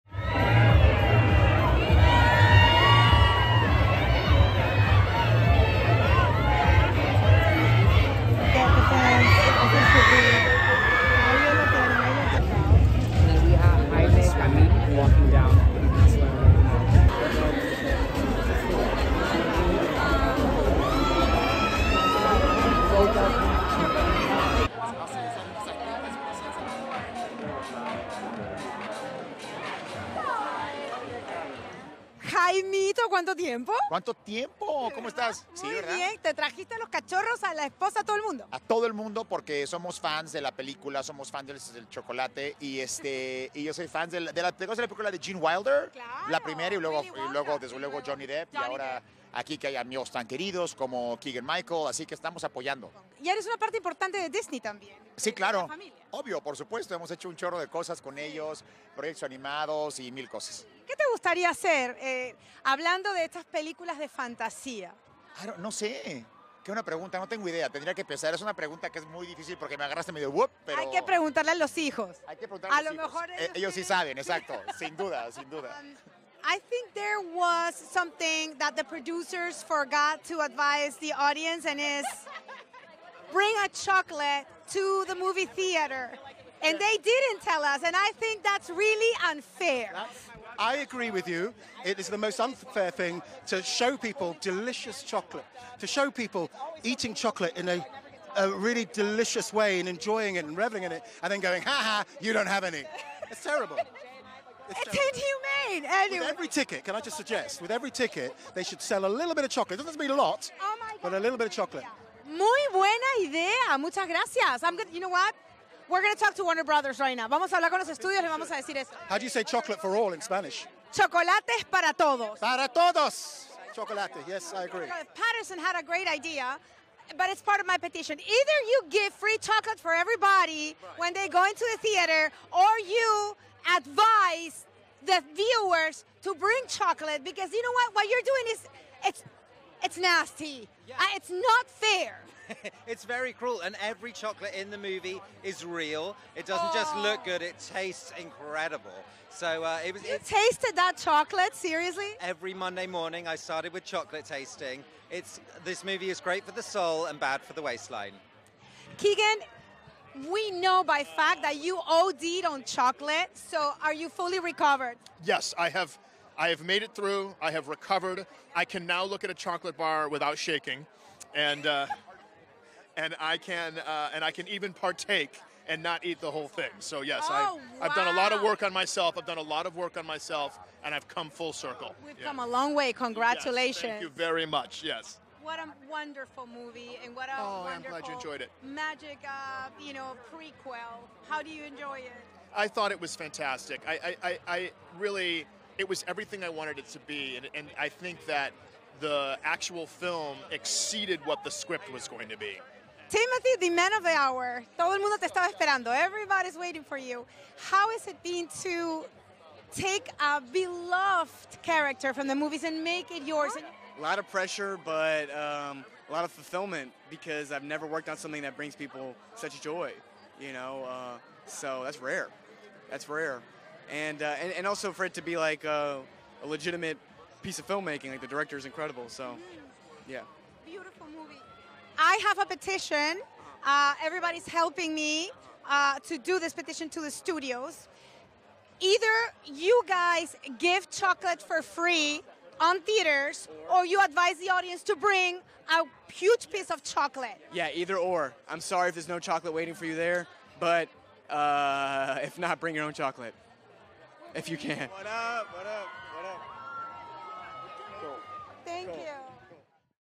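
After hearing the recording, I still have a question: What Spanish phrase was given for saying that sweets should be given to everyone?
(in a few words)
Chocolates para todos.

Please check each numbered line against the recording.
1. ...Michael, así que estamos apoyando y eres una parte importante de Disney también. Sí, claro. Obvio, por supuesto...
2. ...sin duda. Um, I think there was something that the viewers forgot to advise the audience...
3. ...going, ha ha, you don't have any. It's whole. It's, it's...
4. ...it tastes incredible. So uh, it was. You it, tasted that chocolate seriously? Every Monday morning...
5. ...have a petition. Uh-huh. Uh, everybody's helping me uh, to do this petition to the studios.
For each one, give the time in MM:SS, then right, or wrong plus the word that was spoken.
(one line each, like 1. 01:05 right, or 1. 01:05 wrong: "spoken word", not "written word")
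1. 00:51 right
2. 01:15 wrong: "producers", not "viewers"
3. 01:41 wrong: "terrible", not "whole"
4. 02:27 right
5. 03:52 right.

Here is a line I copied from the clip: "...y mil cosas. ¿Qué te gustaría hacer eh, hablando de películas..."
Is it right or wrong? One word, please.
wrong.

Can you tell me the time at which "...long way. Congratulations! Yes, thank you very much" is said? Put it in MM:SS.
03:02.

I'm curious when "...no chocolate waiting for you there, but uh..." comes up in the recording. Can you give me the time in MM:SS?
04:09.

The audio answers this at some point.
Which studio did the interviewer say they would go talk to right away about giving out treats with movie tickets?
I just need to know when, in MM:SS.
01:56.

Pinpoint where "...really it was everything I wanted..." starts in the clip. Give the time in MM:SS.
03:14.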